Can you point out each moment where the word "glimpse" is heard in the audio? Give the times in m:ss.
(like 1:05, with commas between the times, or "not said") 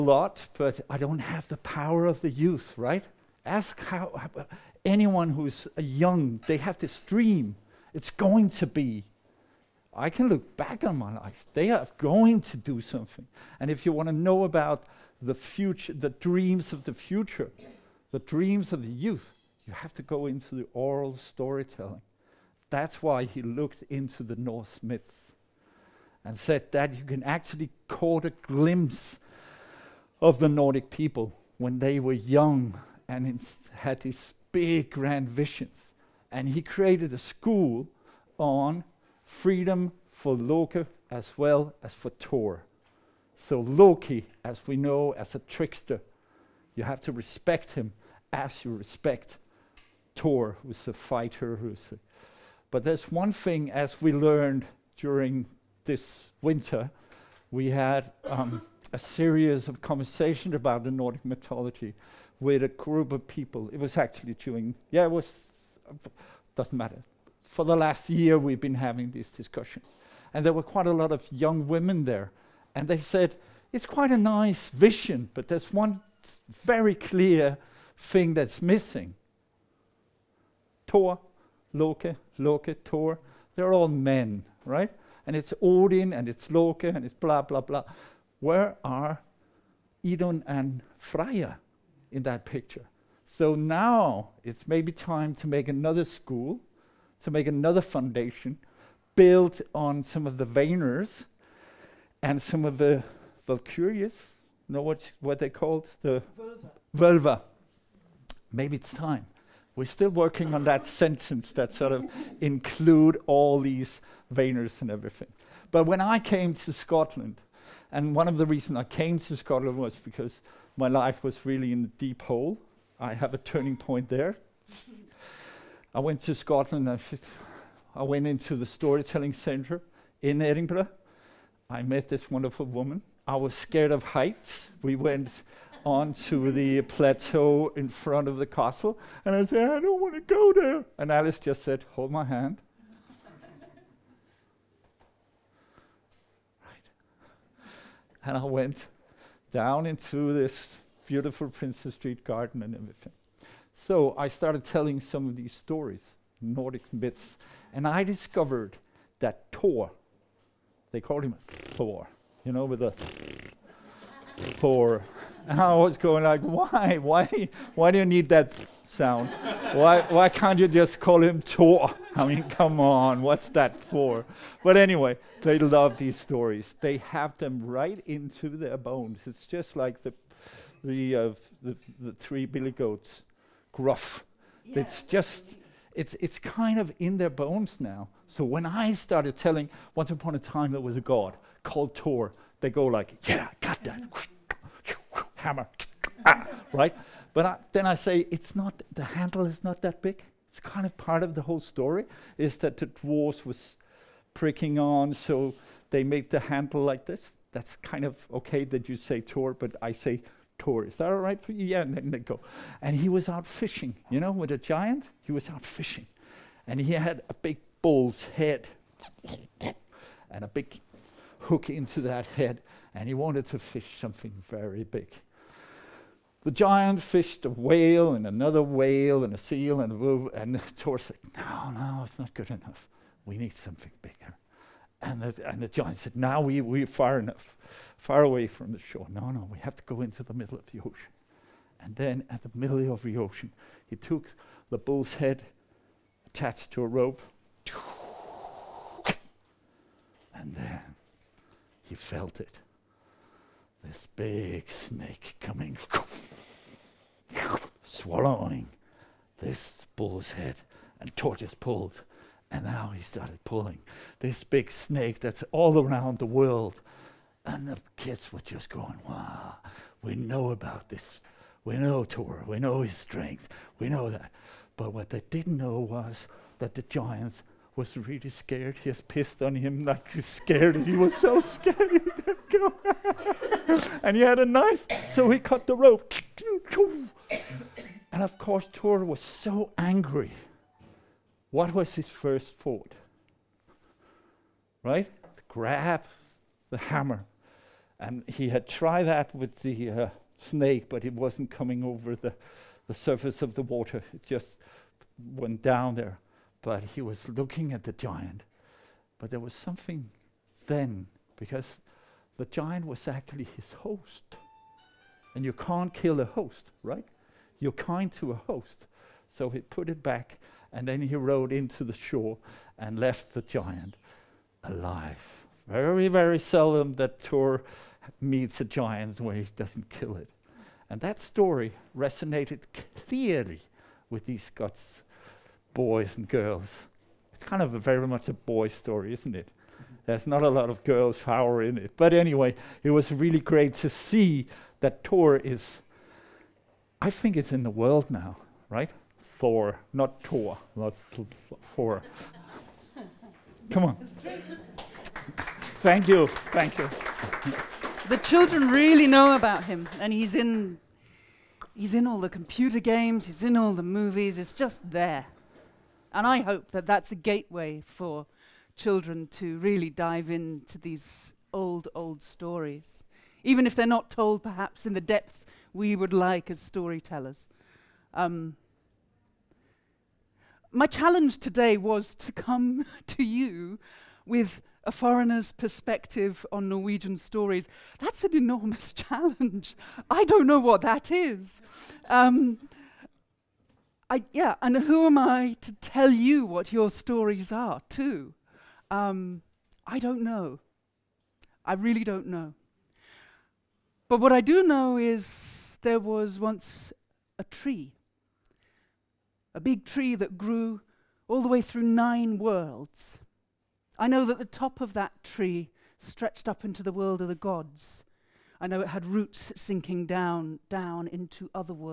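0:28.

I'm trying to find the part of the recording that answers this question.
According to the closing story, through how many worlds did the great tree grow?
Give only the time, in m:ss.
6:51.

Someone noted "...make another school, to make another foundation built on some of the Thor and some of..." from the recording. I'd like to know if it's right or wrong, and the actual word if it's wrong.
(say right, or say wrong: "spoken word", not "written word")
wrong: "Vayners", not "Thor".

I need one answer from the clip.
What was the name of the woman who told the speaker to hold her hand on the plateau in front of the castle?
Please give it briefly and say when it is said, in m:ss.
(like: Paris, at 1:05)
Alice, at 2:21.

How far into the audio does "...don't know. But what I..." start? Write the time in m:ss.
6:42.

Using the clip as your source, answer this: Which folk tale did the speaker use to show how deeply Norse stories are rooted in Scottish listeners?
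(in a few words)
The Three Billy Goats Gruff.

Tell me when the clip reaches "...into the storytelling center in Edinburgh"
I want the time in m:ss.
2:08.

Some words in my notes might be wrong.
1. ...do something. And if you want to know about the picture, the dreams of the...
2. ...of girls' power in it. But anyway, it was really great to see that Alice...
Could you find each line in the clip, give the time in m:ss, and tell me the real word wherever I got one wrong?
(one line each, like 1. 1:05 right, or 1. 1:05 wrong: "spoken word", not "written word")
1. 0:12 wrong: "future", not "picture"
2. 5:40 wrong: "Thor", not "Alice".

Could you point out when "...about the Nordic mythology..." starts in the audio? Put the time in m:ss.
1:00.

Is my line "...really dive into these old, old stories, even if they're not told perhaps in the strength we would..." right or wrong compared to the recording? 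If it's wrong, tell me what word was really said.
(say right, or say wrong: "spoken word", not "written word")
wrong: "depth", not "strength".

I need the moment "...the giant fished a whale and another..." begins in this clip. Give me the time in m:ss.
3:46.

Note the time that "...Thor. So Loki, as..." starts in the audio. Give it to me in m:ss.
0:42.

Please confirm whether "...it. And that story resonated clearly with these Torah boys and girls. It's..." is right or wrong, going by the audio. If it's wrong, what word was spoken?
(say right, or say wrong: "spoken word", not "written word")
wrong: "Scots", not "Torah".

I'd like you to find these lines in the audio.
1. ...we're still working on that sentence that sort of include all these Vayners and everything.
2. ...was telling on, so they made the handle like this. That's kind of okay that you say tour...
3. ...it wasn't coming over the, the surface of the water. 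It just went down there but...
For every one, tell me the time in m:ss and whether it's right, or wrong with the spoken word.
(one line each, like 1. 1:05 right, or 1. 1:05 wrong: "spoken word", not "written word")
1. 1:49 right
2. 3:23 wrong: "pricking", not "telling"
3. 5:01 right.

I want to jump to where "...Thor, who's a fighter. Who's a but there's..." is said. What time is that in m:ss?
0:50.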